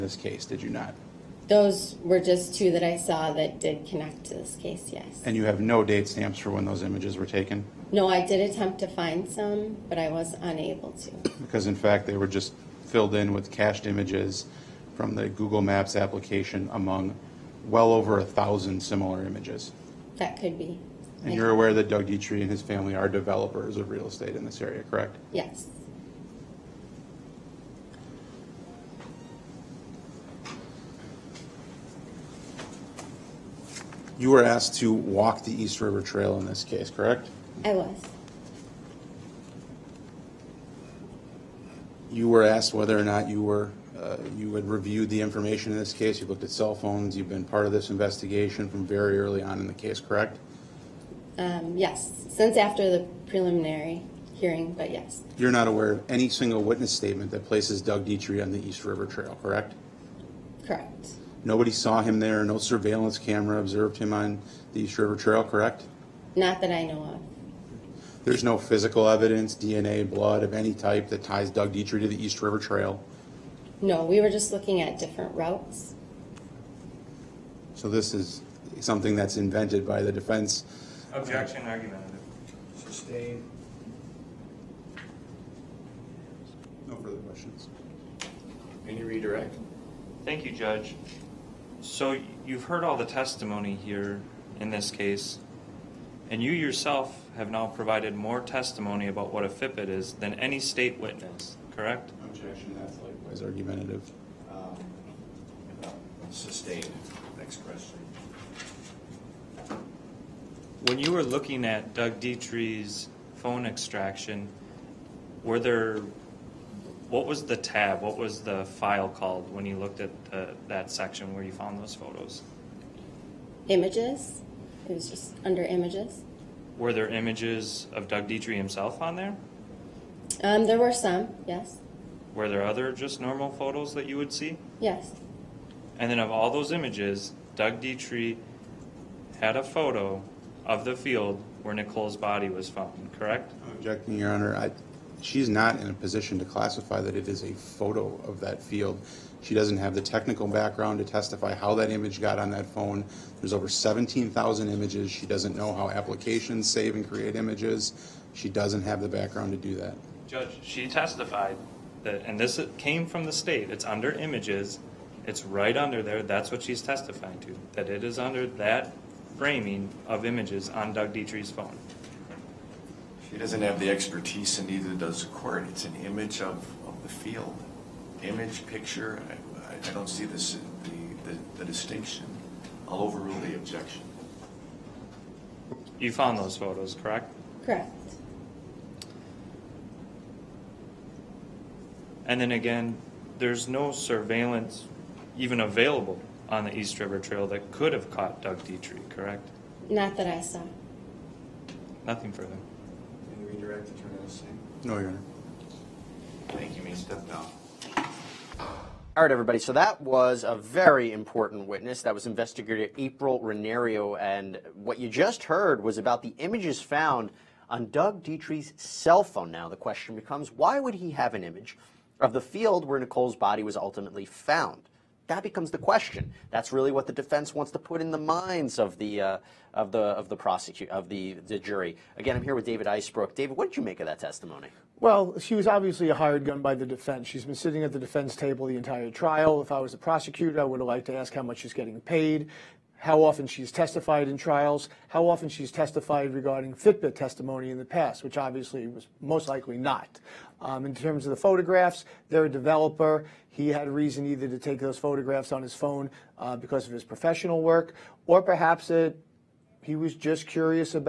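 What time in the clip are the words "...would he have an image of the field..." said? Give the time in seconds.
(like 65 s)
220 s.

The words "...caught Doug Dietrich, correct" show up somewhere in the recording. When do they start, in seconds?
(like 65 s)
198 s.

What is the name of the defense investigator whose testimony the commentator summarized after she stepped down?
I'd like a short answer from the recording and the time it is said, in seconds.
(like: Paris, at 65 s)
April Renario, at 212 s.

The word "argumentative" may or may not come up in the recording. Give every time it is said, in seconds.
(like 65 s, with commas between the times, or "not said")
81 s, 103 s.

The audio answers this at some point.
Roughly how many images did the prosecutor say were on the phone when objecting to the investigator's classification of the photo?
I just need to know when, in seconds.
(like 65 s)
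153 s.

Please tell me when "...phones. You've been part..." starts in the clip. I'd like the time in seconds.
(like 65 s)
46 s.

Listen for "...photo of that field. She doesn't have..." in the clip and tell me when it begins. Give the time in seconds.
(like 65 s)
147 s.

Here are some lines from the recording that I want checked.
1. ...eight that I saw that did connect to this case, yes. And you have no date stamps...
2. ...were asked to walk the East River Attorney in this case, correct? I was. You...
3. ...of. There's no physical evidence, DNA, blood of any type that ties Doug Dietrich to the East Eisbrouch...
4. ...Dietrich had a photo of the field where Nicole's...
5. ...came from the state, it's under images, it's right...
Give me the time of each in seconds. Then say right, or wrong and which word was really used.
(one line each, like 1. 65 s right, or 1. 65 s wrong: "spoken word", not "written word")
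1. 2 s wrong: "two", not "eight"
2. 34 s wrong: "Trail", not "Attorney"
3. 67 s wrong: "River", not "Eisbrouch"
4. 137 s right
5. 162 s right.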